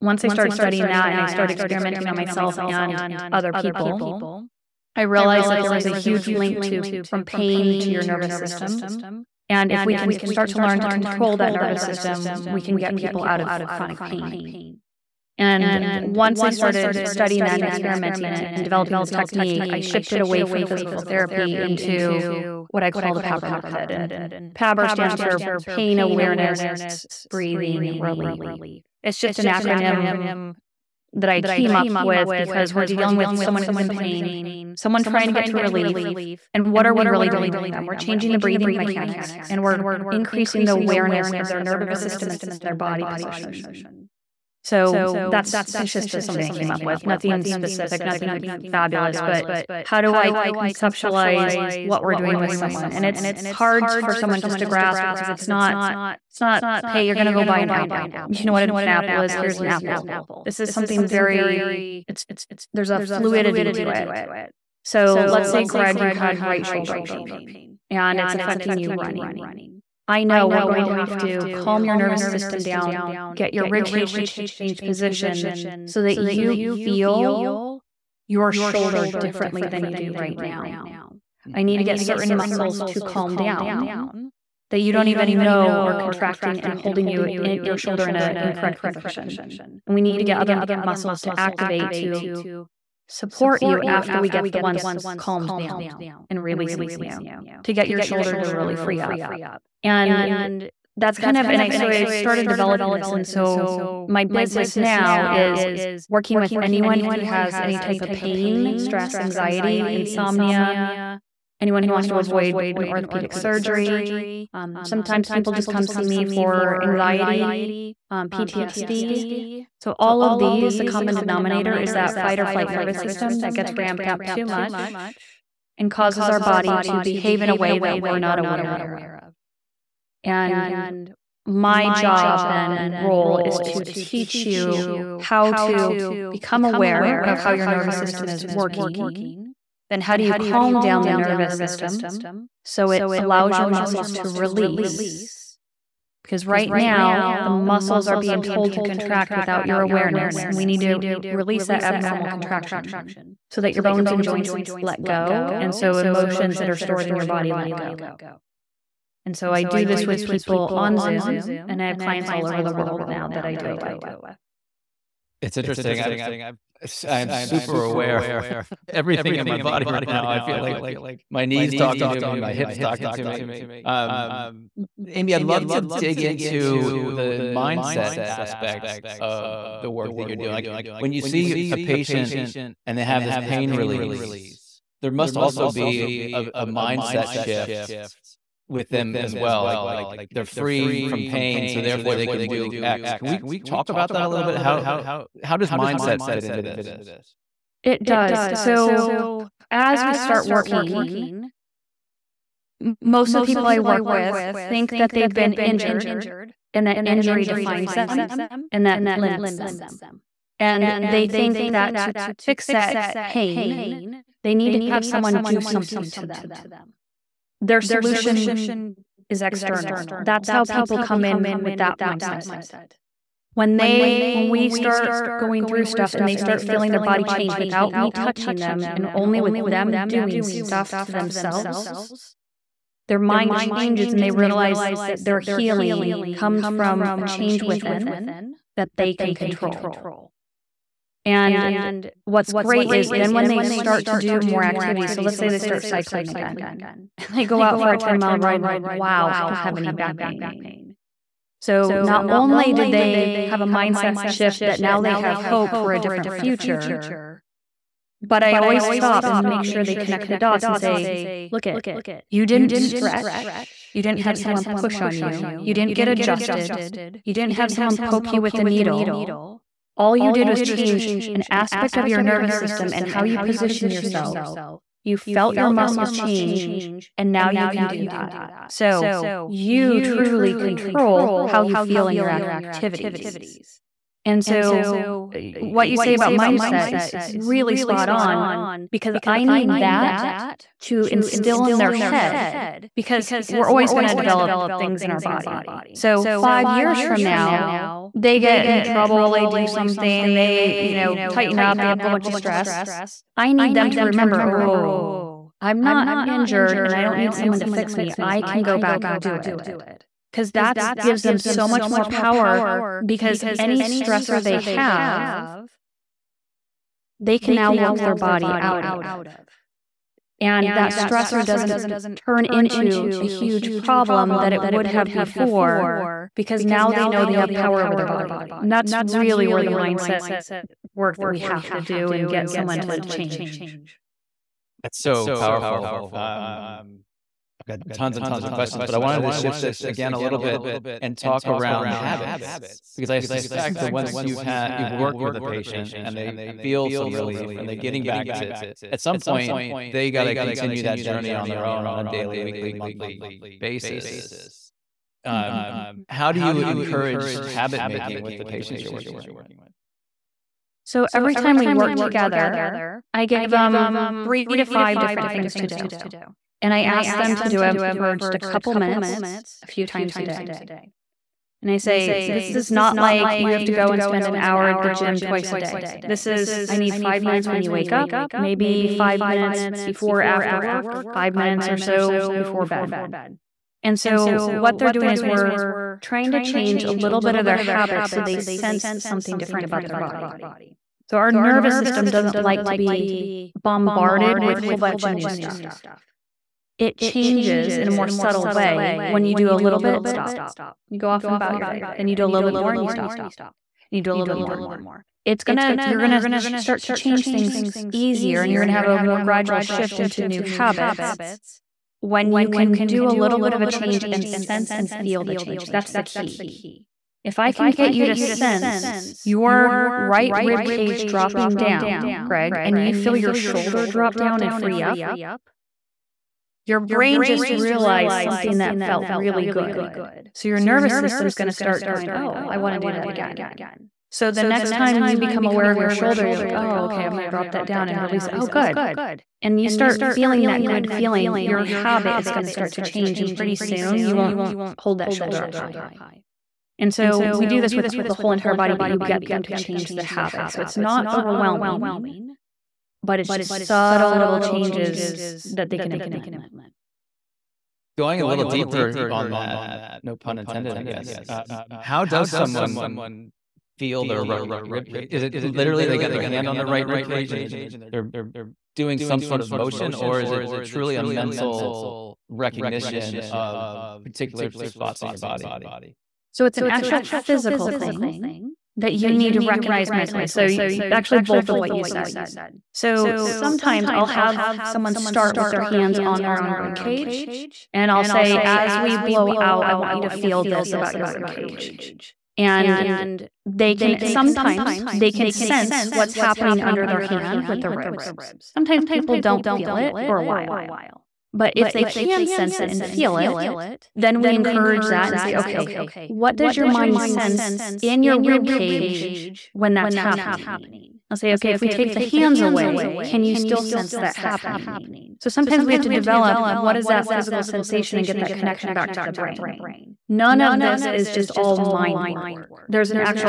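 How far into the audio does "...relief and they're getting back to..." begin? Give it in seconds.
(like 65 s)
347 s.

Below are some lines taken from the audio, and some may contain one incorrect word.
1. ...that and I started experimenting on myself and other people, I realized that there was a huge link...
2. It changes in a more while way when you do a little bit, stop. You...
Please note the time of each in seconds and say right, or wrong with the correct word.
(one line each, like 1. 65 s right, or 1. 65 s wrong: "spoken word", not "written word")
1. 0 s right
2. 396 s wrong: "subtle", not "while".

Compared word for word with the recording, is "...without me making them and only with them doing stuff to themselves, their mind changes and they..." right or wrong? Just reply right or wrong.
wrong.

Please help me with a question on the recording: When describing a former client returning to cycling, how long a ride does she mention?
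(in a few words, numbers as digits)
10 miles.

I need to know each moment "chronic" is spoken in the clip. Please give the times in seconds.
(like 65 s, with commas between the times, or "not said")
13 s.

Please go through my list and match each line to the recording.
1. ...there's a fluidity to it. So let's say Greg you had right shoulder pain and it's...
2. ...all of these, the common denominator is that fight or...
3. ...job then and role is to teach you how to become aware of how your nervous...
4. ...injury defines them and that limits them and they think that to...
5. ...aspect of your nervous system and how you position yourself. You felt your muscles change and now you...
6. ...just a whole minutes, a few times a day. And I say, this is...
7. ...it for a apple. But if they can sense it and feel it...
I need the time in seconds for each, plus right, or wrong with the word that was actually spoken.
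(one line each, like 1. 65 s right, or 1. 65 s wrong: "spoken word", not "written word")
1. 62 s right
2. 119 s right
3. 131 s right
4. 207 s right
5. 271 s right
6. 368 s wrong: "couple", not "whole"
7. 499 s wrong: "while", not "apple".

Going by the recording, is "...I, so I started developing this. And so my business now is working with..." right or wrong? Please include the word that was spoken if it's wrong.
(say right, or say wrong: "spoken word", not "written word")
right.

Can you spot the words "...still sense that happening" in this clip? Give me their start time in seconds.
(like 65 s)
513 s.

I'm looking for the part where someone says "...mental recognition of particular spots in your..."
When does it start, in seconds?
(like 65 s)
471 s.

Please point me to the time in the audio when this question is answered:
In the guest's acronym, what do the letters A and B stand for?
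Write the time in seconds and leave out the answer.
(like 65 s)
25 s.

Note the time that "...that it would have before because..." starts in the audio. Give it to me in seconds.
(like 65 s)
324 s.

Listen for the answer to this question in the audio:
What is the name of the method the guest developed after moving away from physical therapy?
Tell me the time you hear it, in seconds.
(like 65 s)
23 s.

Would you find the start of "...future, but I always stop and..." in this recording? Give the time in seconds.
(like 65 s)
256 s.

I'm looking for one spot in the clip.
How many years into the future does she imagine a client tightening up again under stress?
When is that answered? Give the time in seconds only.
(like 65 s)
296 s.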